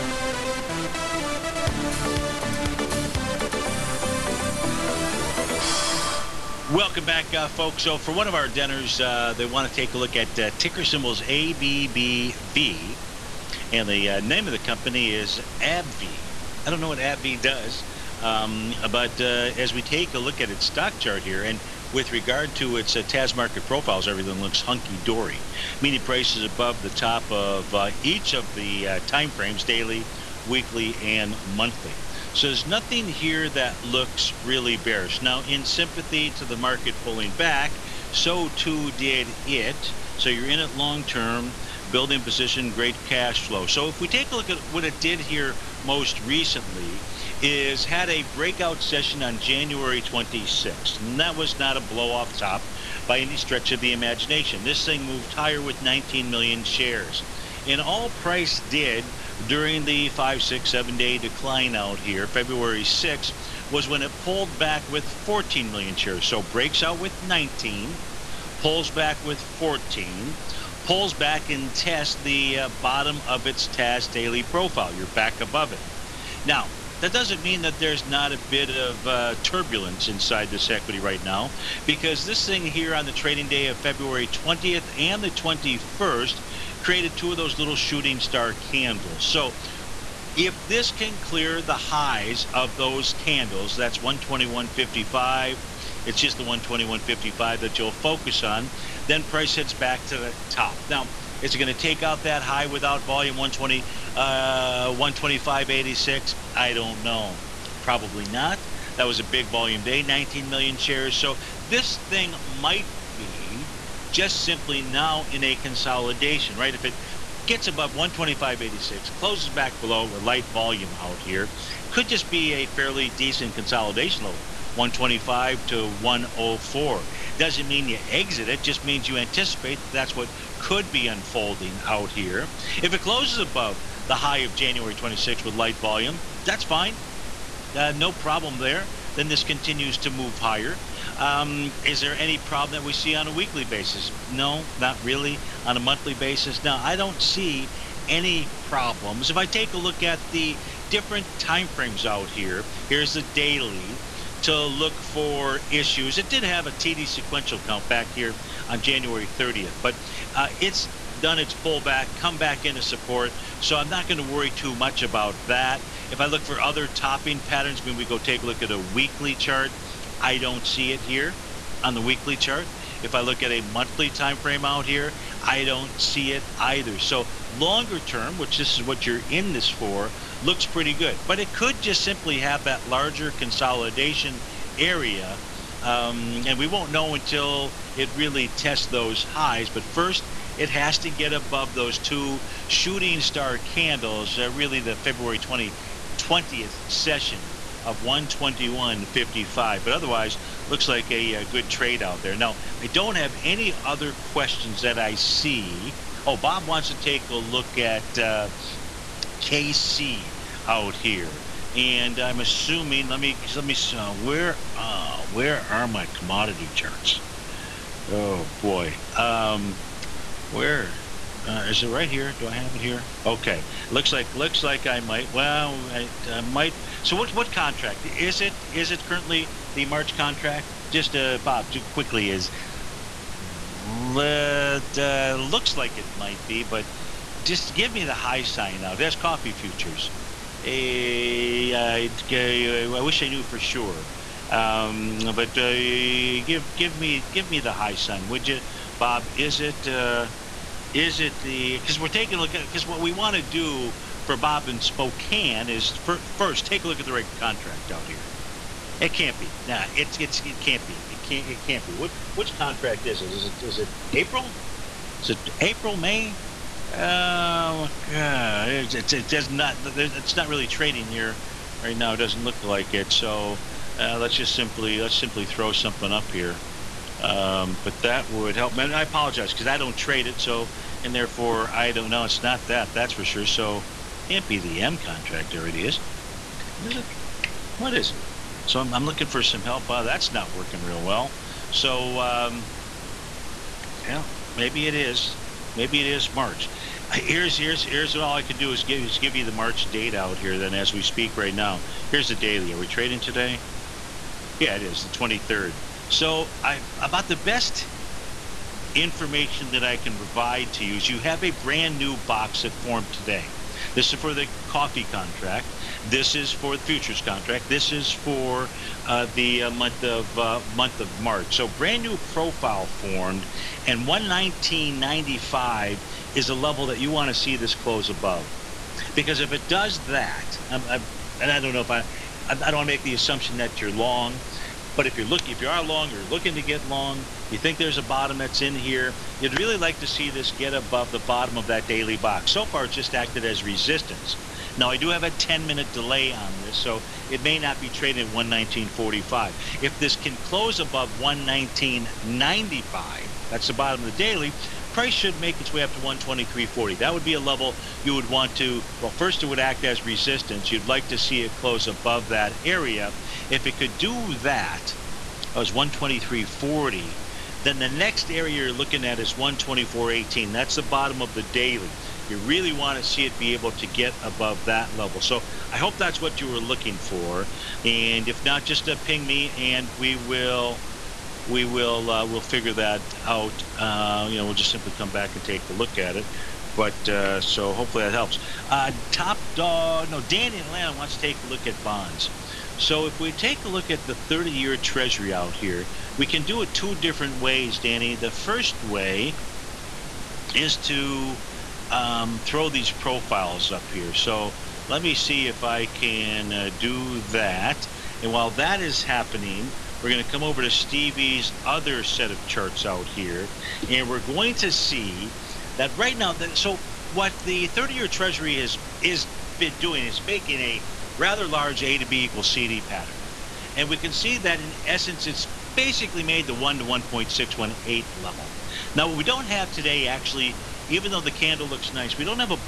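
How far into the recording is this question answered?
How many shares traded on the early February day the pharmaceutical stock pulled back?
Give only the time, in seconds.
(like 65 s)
65 s.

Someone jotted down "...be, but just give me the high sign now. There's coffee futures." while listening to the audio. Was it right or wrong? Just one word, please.
right.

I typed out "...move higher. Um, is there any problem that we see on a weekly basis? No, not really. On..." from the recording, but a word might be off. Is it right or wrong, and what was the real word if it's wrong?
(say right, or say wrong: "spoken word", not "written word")
right.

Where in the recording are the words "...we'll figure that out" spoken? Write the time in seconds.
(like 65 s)
382 s.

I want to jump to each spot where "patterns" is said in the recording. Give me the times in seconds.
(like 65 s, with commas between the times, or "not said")
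167 s, 422 s.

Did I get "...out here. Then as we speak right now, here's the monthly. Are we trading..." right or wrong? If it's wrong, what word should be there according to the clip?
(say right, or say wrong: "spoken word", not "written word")
wrong: "daily", not "monthly".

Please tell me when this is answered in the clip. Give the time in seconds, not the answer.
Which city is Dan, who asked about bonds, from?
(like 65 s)
390 s.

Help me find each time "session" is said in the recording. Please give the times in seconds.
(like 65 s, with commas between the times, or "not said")
48 s, 196 s.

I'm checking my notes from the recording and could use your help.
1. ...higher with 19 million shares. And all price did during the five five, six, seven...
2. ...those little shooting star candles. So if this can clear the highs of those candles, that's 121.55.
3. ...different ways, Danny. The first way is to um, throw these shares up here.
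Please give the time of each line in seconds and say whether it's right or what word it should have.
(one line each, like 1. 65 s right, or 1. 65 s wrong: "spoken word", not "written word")
1. 55 s right
2. 87 s right
3. 396 s wrong: "profiles", not "shares".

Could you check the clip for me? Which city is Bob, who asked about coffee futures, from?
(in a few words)
Spokane.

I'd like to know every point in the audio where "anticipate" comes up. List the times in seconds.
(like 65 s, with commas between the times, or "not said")
129 s.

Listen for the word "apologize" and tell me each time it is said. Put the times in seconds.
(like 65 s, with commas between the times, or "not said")
279 s.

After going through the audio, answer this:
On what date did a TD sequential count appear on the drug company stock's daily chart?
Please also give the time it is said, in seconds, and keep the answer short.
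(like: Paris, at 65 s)
January 30, at 158 s.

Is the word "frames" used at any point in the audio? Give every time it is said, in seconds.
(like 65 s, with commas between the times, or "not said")
29 s, 151 s, 174 s.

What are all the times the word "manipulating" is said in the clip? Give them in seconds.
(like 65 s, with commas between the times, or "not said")
not said.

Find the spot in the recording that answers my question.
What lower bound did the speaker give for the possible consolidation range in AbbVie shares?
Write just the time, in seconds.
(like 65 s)
124 s.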